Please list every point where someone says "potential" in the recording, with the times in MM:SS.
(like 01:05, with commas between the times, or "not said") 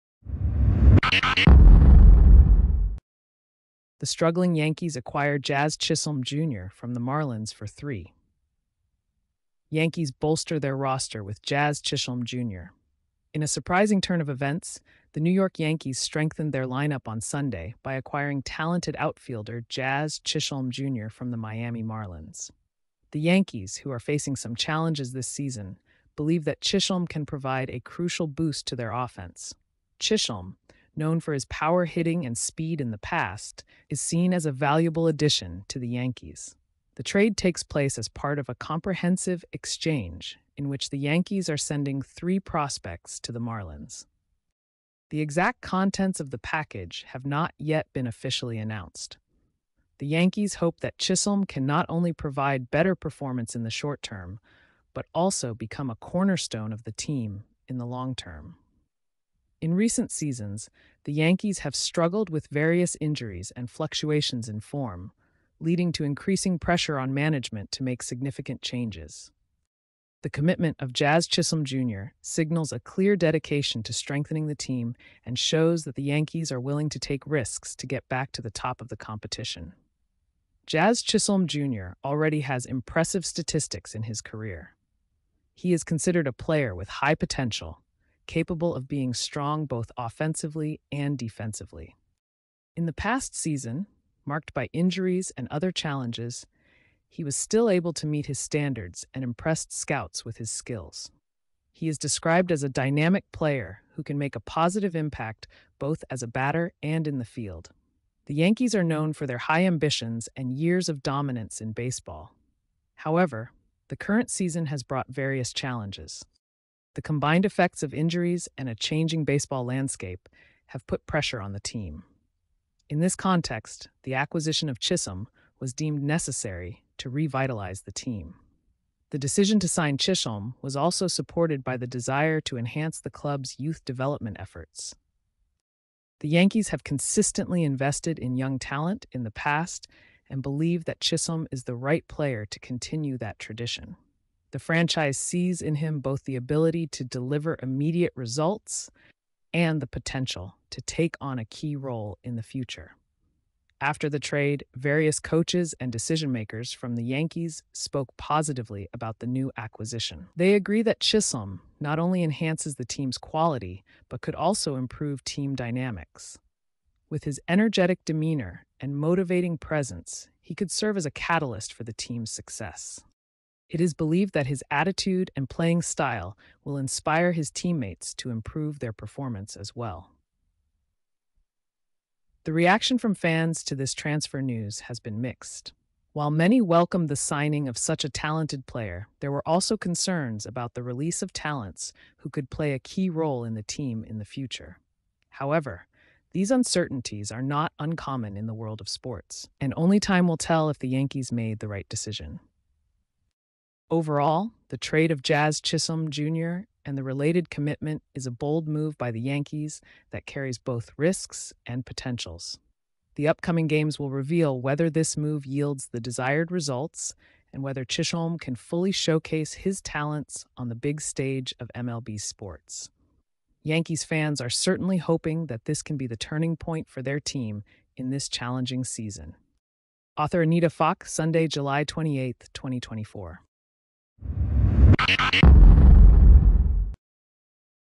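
01:27, 02:29, 03:31.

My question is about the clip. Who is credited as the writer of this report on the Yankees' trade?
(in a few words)
Anita Faake.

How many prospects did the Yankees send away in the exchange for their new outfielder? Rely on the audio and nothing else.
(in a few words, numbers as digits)
3.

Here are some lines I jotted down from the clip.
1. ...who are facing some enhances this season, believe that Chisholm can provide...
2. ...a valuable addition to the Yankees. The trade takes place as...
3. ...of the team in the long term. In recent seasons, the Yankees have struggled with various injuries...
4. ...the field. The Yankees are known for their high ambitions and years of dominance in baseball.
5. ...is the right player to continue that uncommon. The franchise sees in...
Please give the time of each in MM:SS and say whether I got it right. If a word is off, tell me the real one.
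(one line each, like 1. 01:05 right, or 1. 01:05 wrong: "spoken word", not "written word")
1. 00:23 wrong: "challenges", not "enhances"
2. 00:34 right
3. 00:56 right
4. 01:47 right
5. 02:21 wrong: "tradition", not "uncommon".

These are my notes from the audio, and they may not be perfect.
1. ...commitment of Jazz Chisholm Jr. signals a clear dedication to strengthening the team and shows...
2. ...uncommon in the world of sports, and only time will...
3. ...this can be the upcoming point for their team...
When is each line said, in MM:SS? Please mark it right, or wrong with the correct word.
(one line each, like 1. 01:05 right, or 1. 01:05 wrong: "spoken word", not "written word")
1. 01:10 right
2. 03:17 right
3. 03:45 wrong: "turning", not "upcoming".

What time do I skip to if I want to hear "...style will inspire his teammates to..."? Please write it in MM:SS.
02:55.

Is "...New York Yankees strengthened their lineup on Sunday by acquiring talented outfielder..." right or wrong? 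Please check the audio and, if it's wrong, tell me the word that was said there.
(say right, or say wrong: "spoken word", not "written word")
right.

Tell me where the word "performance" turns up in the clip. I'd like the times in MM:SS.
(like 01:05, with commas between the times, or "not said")
00:52, 02:58.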